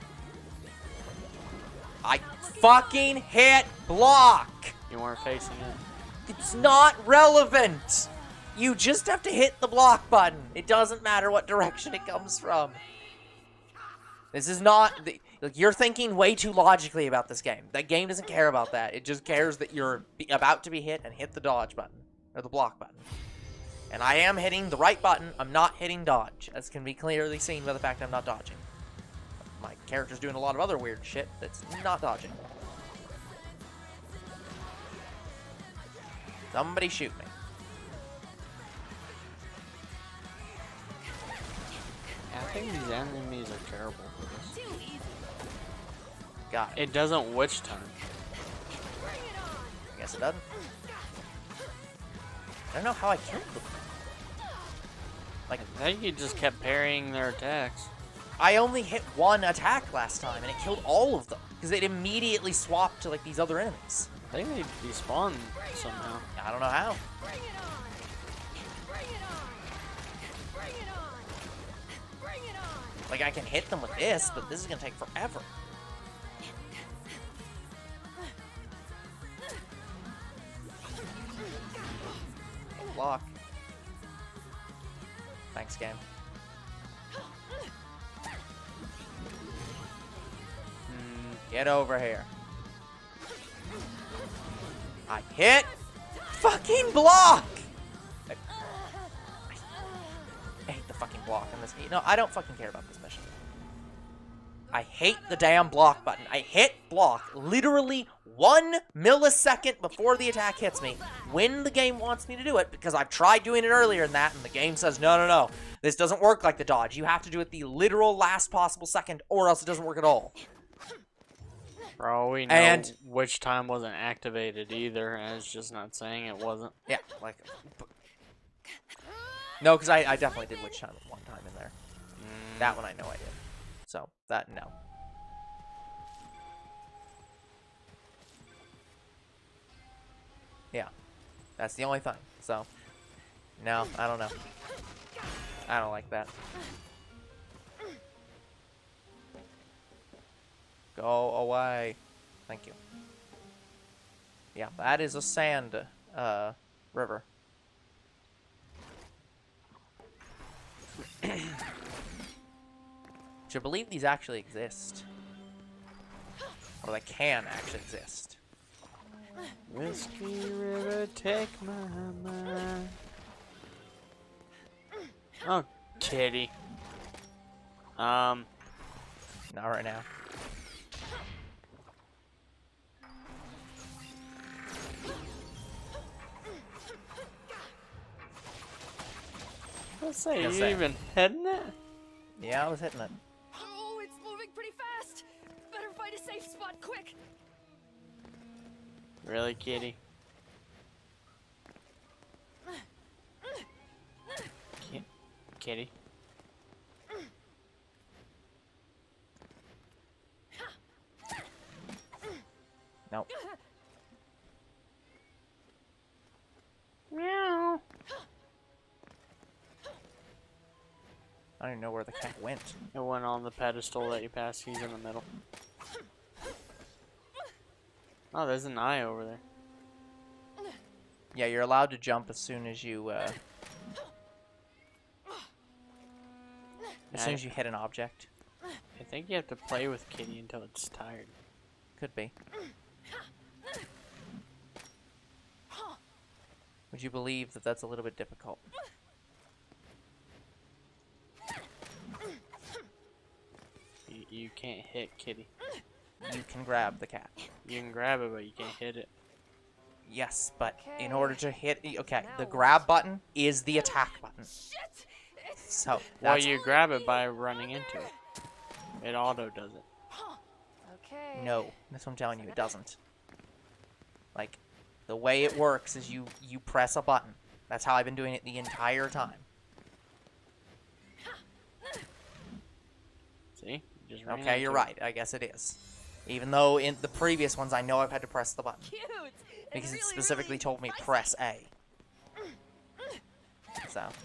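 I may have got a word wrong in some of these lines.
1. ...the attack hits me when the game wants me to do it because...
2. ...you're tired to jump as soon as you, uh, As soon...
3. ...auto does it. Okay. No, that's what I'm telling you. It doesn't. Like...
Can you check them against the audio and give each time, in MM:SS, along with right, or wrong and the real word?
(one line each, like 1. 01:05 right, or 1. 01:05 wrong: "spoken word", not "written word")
1. 01:50 right
2. 03:51 wrong: "allowed", not "tired"
3. 04:29 right.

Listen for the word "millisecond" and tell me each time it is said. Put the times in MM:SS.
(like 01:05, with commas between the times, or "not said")
01:48.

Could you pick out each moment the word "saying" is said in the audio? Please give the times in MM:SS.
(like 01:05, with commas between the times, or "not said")
02:05.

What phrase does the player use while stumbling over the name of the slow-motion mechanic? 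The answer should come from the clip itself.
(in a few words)
Witch Hunt.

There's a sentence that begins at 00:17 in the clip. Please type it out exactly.
That game doesn't care about that.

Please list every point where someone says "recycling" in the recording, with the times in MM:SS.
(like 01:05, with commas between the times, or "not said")
not said.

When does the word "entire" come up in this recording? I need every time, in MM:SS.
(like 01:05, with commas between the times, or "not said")
04:38.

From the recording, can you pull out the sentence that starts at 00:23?
And I am hitting the right button.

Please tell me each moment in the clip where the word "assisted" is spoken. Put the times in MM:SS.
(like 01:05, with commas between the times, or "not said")
not said.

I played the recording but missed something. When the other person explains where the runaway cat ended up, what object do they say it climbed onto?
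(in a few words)
the pedestal.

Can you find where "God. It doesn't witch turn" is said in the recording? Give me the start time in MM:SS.
00:46.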